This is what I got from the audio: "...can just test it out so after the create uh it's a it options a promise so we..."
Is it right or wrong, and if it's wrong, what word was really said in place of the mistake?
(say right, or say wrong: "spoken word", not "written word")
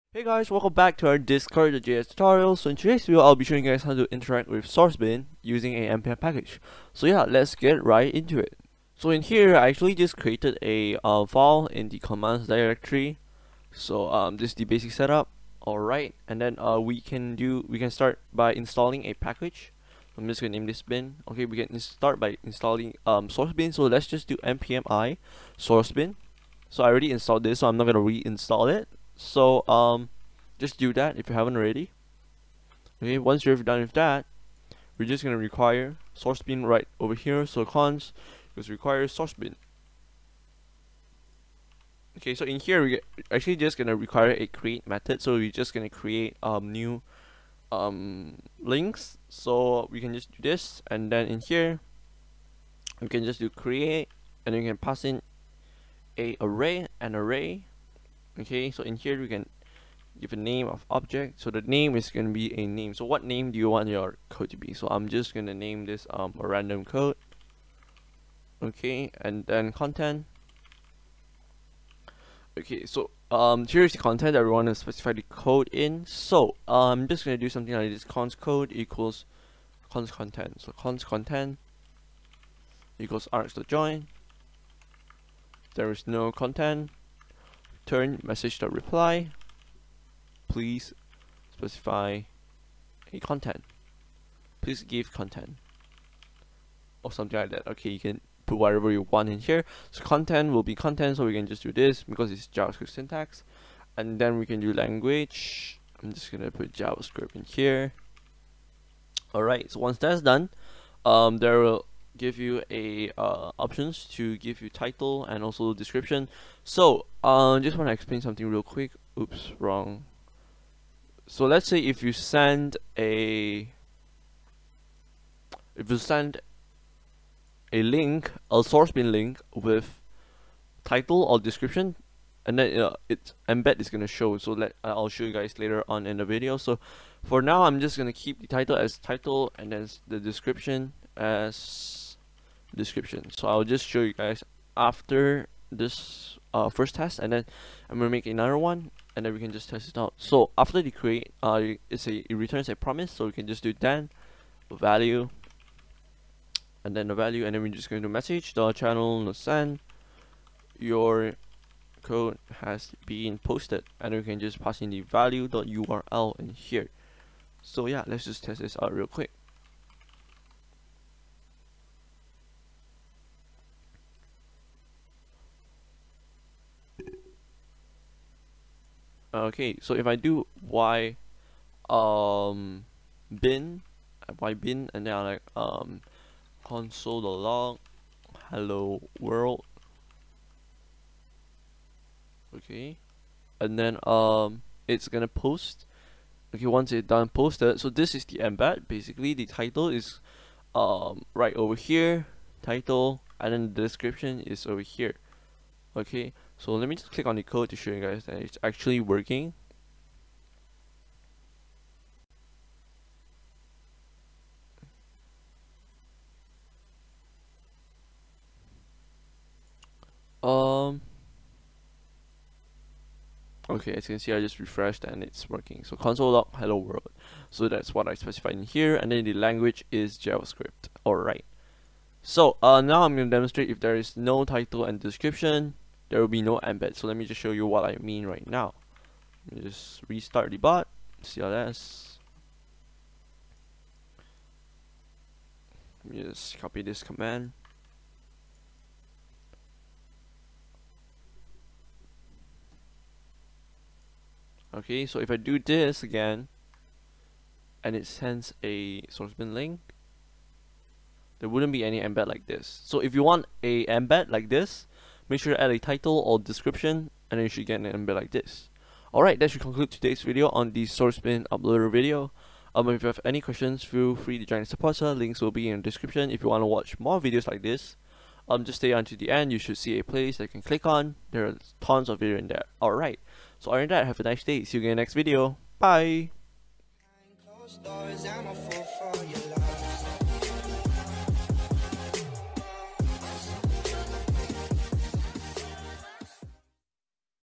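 wrong: "returns", not "options".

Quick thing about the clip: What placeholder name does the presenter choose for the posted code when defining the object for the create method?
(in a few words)
a random code.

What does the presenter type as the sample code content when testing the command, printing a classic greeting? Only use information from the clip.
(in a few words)
console.log hello world.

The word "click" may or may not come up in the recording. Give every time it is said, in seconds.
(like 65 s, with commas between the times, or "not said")
207 s, 280 s.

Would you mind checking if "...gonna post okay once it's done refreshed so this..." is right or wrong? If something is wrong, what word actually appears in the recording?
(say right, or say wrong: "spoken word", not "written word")
wrong: "posted", not "refreshed".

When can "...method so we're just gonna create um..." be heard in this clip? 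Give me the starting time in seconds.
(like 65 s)
44 s.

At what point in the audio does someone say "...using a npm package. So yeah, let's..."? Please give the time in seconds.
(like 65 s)
5 s.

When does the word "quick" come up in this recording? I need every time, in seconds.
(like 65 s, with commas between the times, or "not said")
118 s, 169 s.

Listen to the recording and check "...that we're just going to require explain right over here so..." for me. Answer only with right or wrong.
wrong.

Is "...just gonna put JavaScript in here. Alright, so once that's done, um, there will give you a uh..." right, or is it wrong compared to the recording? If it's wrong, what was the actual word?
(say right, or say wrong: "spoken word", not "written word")
right.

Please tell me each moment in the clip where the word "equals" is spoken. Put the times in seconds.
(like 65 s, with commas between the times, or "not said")
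78 s, 82 s.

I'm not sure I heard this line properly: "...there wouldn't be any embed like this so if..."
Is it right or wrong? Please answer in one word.
right.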